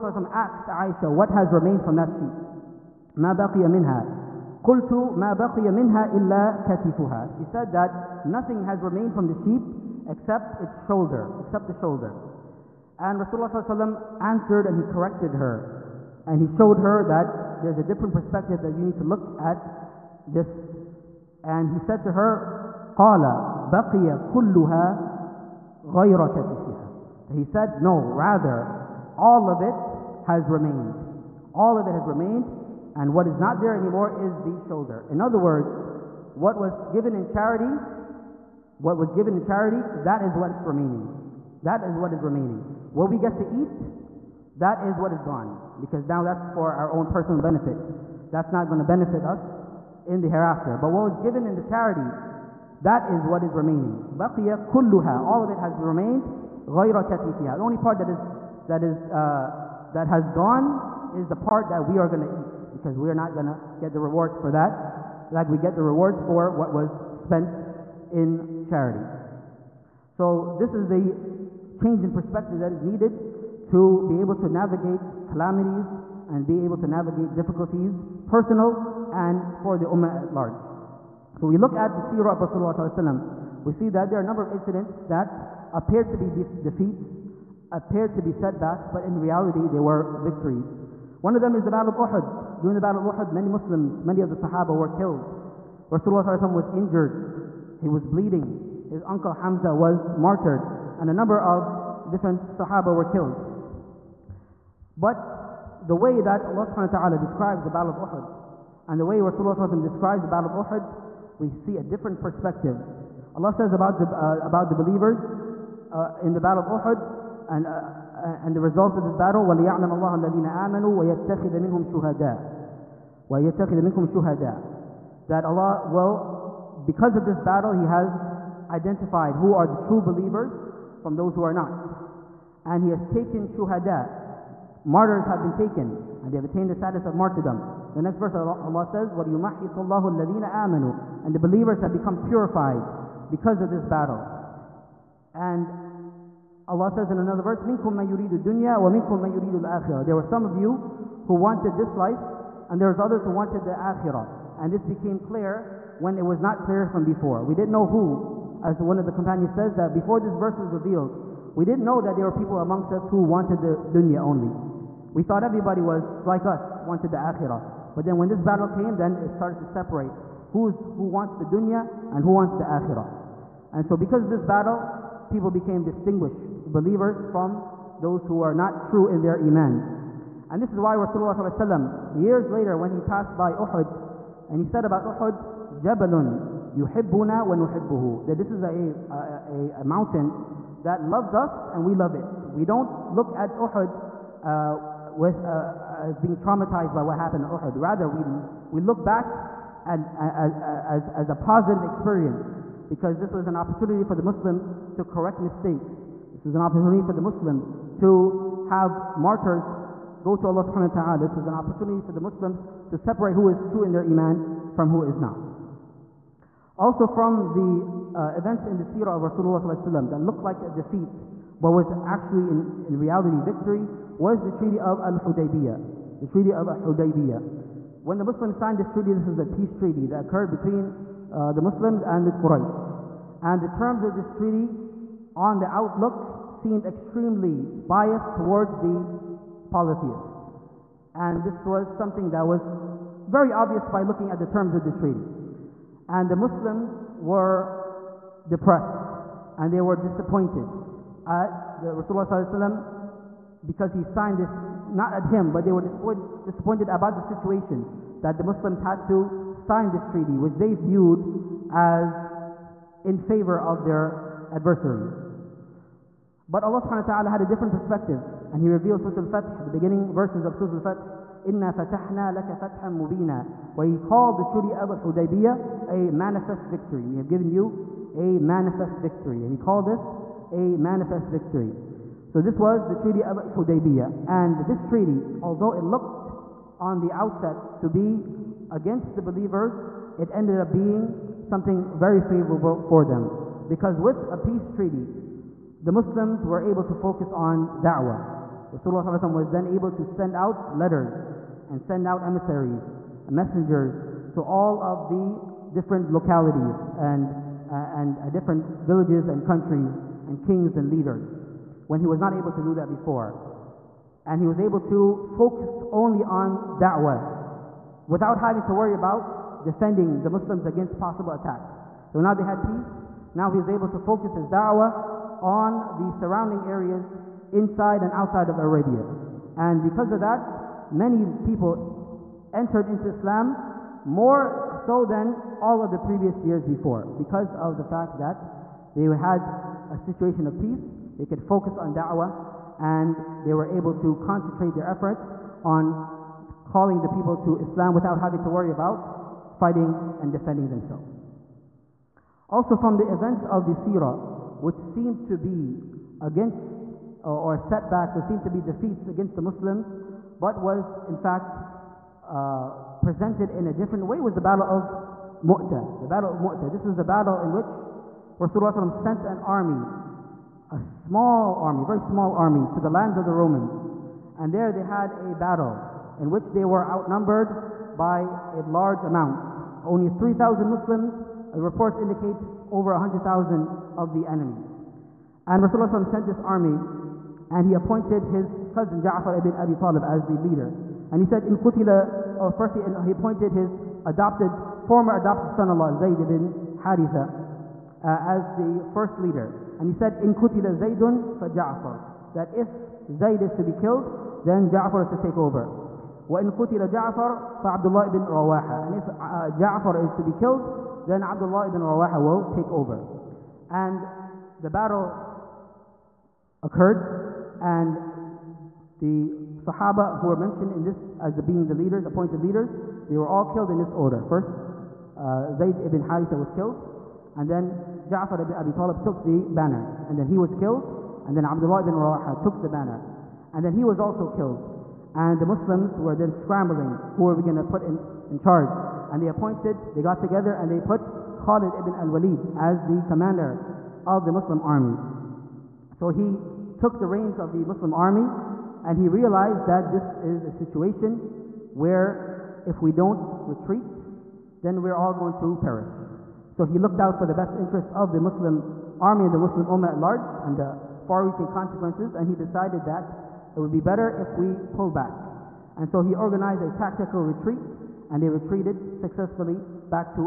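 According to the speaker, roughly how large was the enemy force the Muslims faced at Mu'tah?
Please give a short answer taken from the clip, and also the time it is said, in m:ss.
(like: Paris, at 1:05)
Over 100,000, at 6:22.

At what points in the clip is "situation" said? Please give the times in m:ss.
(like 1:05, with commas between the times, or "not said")
4:17, 5:39, 7:30.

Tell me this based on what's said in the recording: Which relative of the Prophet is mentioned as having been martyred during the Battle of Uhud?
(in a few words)
His uncle Hamza.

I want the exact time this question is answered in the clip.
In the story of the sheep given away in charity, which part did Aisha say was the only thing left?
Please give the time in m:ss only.
0:06.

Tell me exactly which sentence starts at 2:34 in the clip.
And this became clear when it was not clear from before.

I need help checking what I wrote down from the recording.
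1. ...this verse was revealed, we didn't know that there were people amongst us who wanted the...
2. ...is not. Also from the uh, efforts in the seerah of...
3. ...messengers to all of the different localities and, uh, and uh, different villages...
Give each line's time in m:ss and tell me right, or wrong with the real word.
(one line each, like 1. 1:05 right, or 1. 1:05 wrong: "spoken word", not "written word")
1. 2:40 right
2. 3:35 wrong: "events", not "efforts"
3. 5:03 right.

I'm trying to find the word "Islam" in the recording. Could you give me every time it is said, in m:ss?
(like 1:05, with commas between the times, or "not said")
5:33, 5:47.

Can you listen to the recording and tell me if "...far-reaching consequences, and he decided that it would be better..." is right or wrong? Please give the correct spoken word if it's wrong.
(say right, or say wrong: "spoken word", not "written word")
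right.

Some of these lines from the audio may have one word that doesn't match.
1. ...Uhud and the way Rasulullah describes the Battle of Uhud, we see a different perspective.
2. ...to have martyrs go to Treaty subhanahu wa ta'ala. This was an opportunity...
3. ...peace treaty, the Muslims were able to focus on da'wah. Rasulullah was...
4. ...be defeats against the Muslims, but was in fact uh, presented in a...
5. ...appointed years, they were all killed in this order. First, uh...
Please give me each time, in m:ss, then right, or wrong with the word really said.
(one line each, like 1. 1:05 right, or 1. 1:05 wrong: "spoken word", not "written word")
1. 1:48 right
2. 3:28 wrong: "Allah", not "Treaty"
3. 4:54 right
4. 5:58 right
5. 7:02 wrong: "leaders", not "years".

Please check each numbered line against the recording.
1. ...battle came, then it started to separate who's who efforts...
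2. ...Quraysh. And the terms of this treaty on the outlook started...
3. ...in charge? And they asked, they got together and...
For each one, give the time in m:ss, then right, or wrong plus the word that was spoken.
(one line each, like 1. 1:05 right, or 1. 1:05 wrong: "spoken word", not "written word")
1. 2:48 wrong: "wants", not "efforts"
2. 3:52 wrong: "seemed", not "started"
3. 7:18 wrong: "appointed", not "asked".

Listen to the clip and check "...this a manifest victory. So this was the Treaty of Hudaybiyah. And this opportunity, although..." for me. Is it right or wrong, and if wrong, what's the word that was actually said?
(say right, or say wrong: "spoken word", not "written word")
wrong: "treaty", not "opportunity".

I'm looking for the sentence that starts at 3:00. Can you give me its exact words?
And this is why Rasulullah ﷺ, years later when he passed by Uhud, and he said about Uhud, Jabalun yuhibbuna wa nuhibbuhu.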